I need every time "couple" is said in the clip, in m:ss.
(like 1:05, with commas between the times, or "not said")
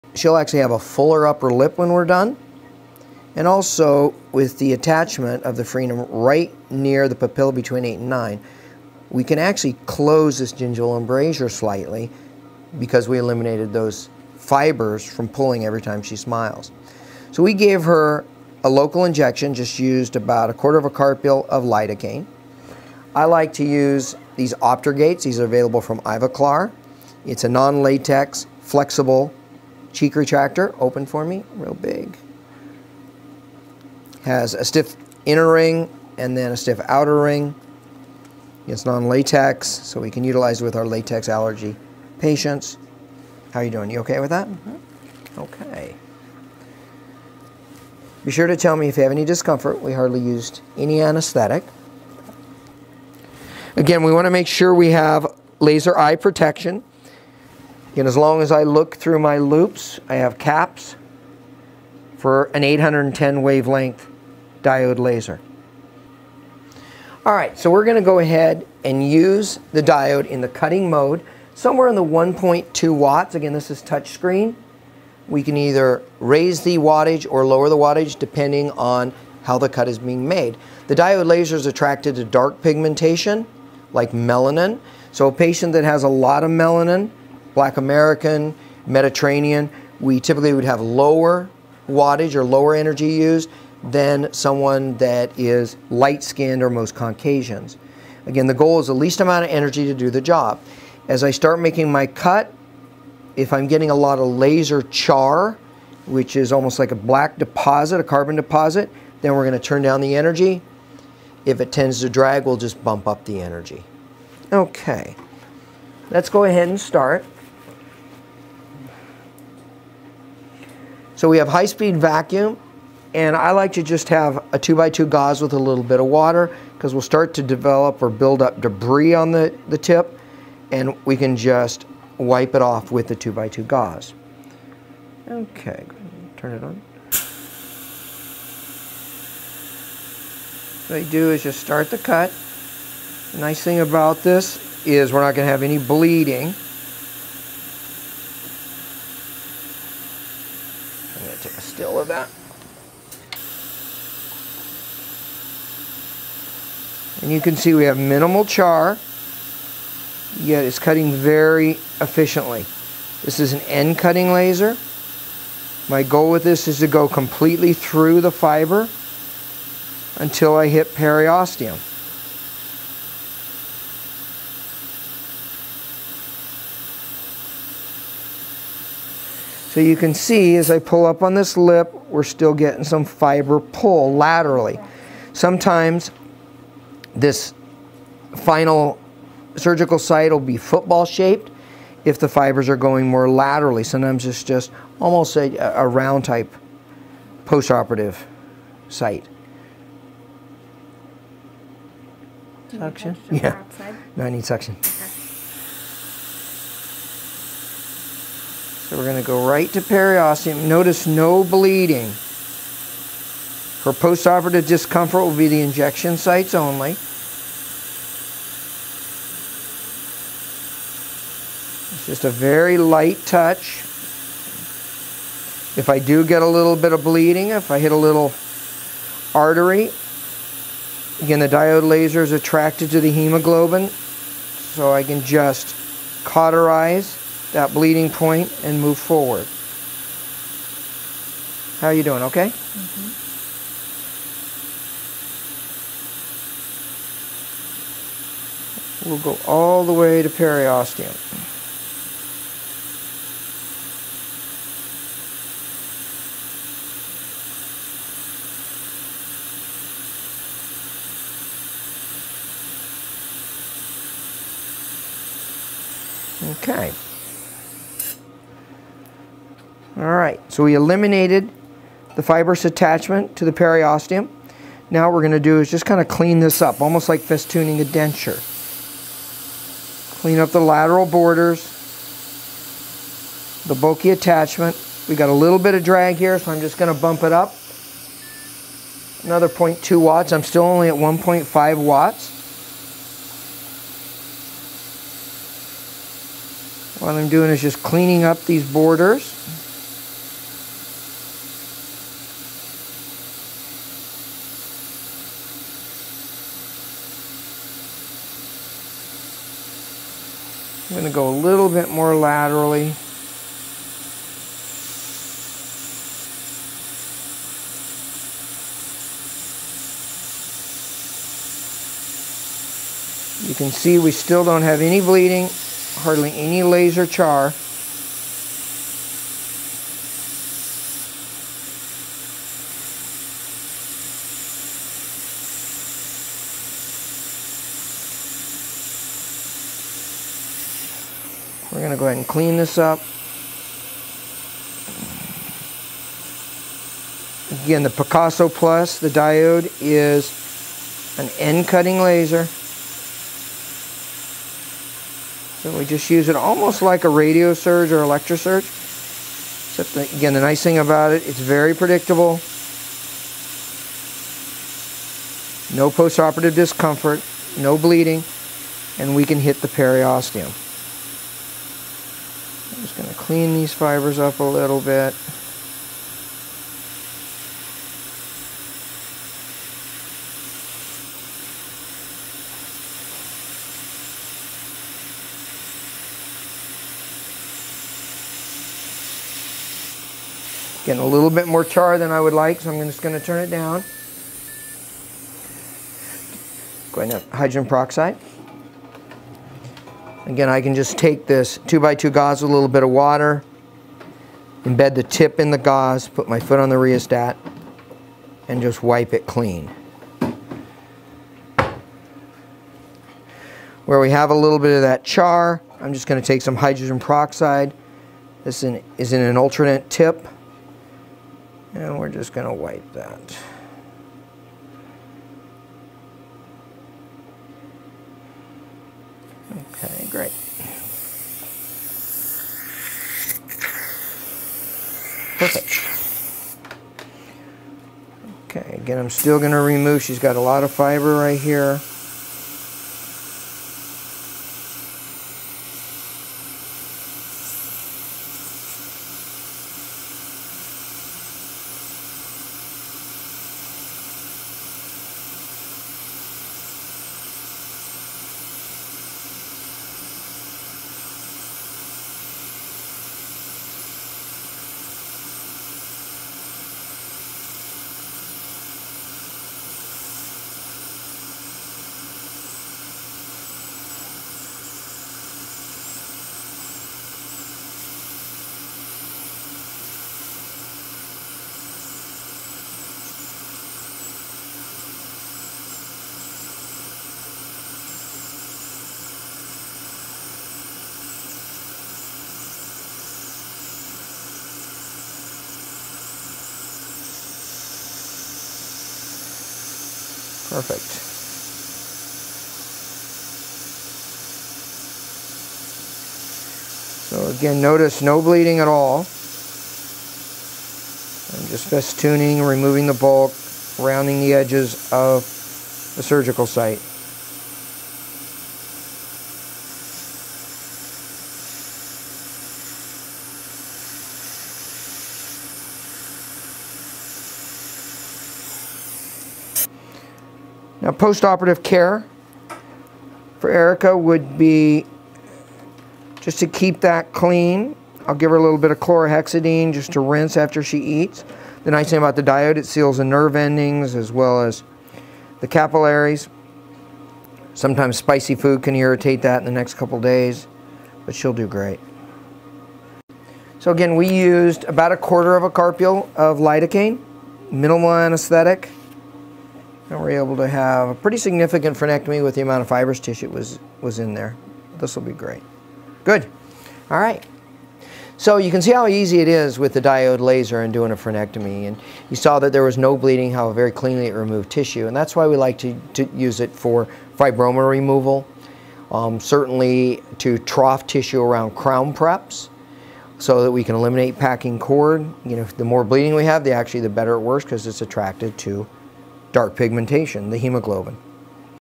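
9:09.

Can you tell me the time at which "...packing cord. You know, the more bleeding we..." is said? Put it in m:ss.
9:44.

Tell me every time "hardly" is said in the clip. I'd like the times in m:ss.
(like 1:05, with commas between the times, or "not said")
0:49, 5:25.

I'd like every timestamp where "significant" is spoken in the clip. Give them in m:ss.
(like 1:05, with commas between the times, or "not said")
9:21.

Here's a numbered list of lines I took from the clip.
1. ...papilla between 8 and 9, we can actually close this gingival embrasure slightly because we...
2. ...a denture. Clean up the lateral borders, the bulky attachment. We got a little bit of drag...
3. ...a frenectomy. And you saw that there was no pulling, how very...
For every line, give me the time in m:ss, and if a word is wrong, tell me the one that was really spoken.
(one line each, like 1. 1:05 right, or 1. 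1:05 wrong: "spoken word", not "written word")
1. 0:07 right
2. 4:37 right
3. 9:30 wrong: "bleeding", not "pulling".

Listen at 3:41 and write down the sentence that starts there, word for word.
It's just a very light touch.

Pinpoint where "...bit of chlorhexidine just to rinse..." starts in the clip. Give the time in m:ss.
8:58.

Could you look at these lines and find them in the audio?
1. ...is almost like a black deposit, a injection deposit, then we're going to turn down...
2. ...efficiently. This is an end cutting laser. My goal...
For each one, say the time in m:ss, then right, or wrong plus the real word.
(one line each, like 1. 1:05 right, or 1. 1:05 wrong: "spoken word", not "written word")
1. 1:46 wrong: "carbon", not "injection"
2. 2:42 right.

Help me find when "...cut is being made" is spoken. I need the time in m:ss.
1:19.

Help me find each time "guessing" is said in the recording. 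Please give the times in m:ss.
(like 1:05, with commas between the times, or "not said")
not said.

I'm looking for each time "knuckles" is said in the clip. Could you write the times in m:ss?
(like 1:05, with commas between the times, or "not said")
not said.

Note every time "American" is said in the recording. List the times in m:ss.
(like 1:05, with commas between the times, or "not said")
1:27.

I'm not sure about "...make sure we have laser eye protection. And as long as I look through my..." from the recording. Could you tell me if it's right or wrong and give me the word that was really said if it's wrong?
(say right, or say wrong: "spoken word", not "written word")
right.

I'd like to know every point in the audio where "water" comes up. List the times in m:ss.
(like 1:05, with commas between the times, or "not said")
2:06, 6:42.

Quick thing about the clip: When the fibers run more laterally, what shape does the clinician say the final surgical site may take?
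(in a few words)
football shaped.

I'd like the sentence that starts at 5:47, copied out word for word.
Again, the Picasso Plus, the diode is an end cutting laser.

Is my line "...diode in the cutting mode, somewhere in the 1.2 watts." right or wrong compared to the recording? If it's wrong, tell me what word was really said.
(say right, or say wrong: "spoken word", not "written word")
right.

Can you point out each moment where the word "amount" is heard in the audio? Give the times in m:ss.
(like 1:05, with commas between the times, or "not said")
1:39, 9:22.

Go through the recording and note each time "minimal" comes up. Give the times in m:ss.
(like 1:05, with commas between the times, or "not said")
2:37, 9:17.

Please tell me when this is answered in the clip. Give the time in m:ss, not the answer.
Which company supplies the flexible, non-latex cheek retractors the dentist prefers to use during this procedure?
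0:26.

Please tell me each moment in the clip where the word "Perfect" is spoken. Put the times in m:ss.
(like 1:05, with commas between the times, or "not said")
7:15, 8:20.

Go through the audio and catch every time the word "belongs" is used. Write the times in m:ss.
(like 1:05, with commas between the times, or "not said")
not said.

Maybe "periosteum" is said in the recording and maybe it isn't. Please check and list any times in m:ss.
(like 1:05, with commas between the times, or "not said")
2:50, 3:29, 4:10, 4:33, 6:09.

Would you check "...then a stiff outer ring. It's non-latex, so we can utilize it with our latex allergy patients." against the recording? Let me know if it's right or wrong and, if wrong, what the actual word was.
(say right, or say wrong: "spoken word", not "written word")
right.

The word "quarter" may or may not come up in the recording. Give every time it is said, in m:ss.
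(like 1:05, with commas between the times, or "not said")
0:20, 9:14.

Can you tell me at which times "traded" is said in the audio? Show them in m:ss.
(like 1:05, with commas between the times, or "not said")
not said.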